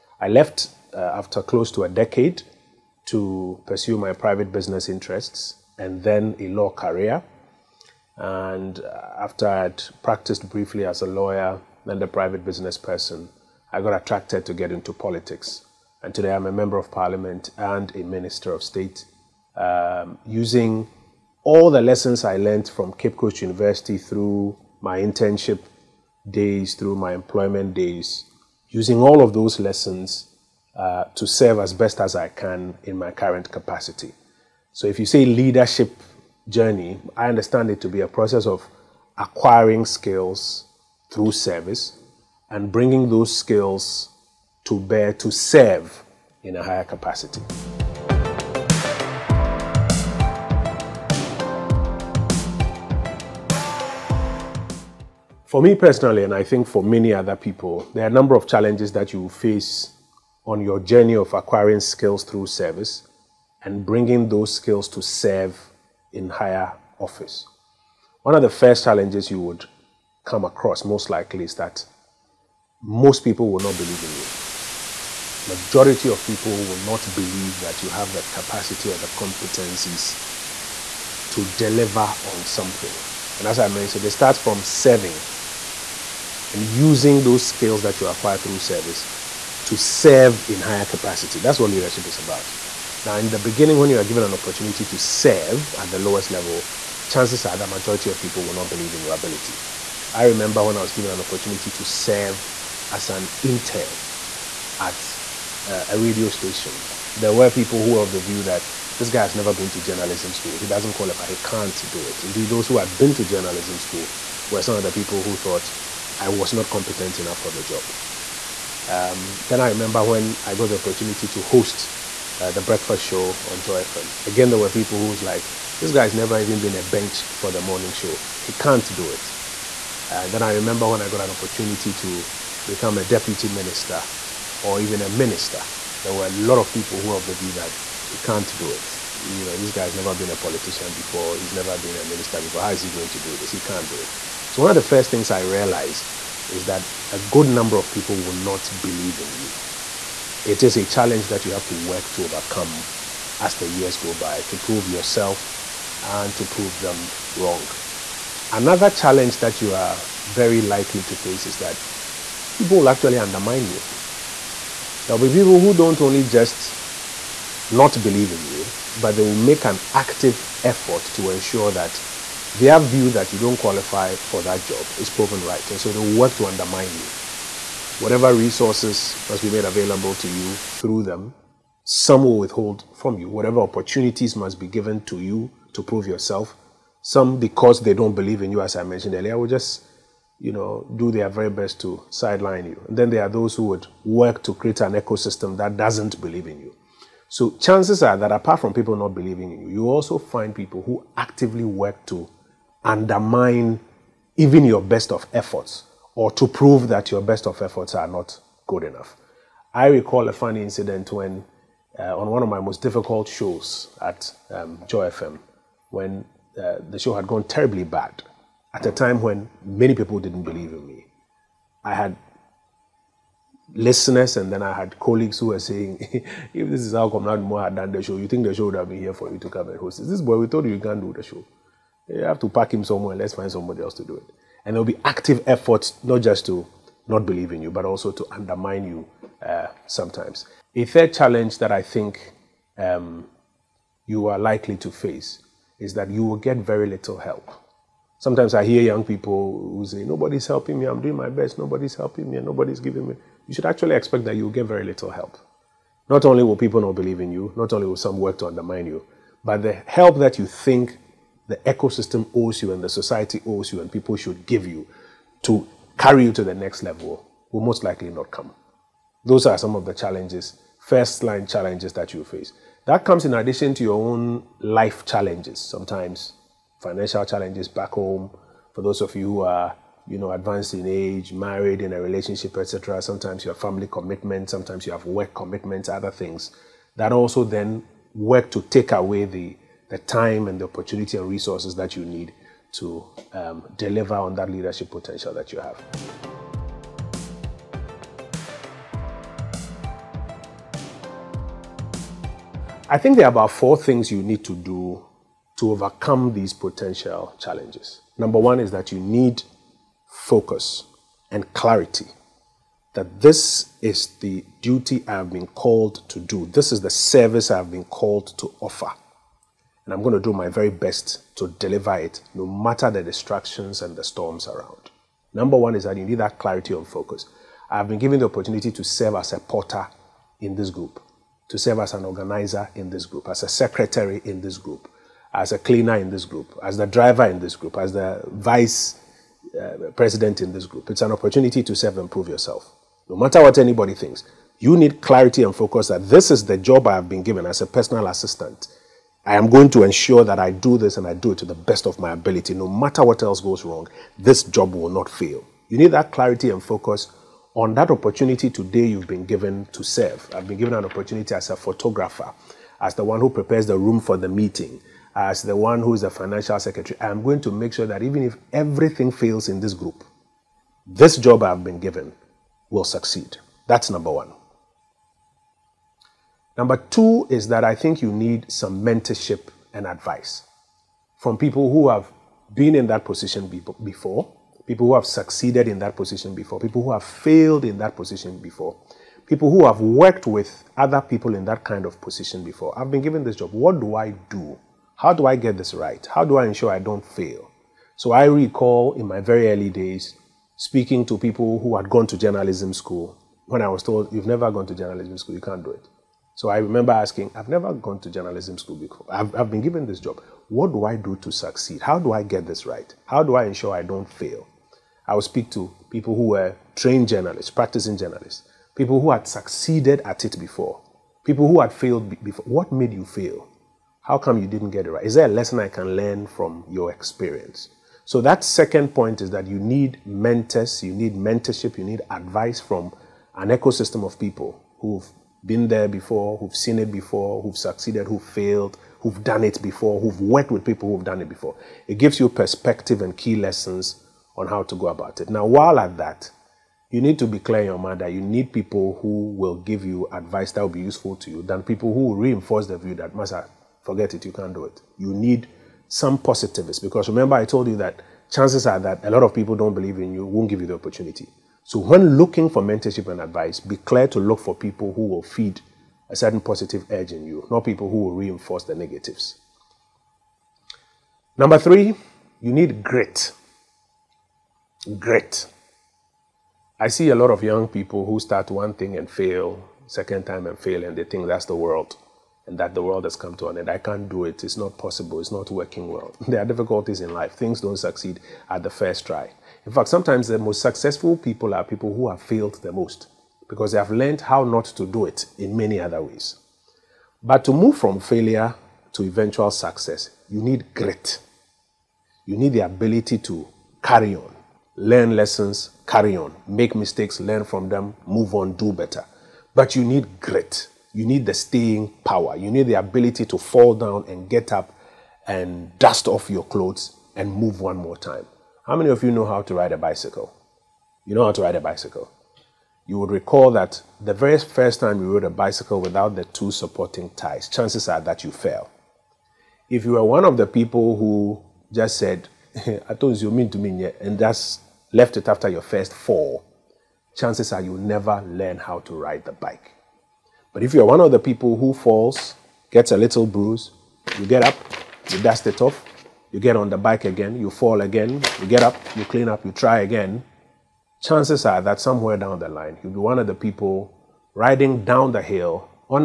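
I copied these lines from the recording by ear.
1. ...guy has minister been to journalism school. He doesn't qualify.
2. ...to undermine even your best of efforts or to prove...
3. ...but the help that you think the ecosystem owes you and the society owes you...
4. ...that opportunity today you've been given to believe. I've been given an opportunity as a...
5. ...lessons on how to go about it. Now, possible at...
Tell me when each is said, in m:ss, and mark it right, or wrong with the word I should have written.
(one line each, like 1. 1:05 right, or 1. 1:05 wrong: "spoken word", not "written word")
1. 1:49 wrong: "never", not "minister"
2. 3:22 right
3. 4:19 right
4. 5:57 wrong: "serve", not "believe"
5. 7:23 wrong: "while", not "possible".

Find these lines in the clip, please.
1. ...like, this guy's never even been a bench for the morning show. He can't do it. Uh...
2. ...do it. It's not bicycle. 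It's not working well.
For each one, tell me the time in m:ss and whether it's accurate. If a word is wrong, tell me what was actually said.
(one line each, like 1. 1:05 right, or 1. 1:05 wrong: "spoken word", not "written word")
1. 2:05 right
2. 8:04 wrong: "possible", not "bicycle".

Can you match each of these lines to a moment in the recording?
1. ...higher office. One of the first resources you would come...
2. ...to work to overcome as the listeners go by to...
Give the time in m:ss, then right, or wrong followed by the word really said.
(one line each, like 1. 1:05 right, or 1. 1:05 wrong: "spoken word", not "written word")
1. 1:06 wrong: "challenges", not "resources"
2. 2:31 wrong: "years", not "listeners".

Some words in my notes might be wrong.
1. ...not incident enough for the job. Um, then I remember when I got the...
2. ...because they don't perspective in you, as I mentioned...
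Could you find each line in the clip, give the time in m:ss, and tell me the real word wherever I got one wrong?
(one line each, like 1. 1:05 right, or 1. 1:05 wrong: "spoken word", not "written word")
1. 1:56 wrong: "competent", not "incident"
2. 3:07 wrong: "believe", not "perspective".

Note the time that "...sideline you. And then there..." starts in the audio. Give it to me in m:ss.
3:12.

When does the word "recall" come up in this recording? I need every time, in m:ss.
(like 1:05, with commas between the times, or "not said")
3:29, 6:38, 8:43.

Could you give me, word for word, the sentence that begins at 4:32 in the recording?
That comes in addition to your own life challenges, sometimes financial challenges back home.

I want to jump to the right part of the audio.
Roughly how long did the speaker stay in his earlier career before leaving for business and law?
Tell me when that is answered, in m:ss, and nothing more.
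0:01.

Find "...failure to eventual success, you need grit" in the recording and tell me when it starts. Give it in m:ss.
8:17.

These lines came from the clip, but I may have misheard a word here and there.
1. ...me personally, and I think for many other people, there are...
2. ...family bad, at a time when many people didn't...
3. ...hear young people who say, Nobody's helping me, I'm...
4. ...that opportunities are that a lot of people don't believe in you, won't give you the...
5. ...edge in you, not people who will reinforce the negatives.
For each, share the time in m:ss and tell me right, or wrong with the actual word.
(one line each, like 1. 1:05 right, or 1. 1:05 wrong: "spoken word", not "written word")
1. 0:55 right
2. 3:37 wrong: "terribly", not "family"
3. 4:08 right
4. 7:37 wrong: "chances", not "opportunities"
5. 7:46 right.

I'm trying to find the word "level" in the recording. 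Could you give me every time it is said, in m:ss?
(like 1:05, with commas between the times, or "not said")
1:36, 4:26.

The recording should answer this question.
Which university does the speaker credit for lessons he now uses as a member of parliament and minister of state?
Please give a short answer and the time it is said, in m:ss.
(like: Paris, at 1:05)
Cape Coast University, at 0:22.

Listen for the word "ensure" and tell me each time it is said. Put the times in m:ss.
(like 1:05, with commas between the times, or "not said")
2:51, 5:49, 6:36, 6:53.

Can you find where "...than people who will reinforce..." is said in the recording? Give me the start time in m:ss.
7:31.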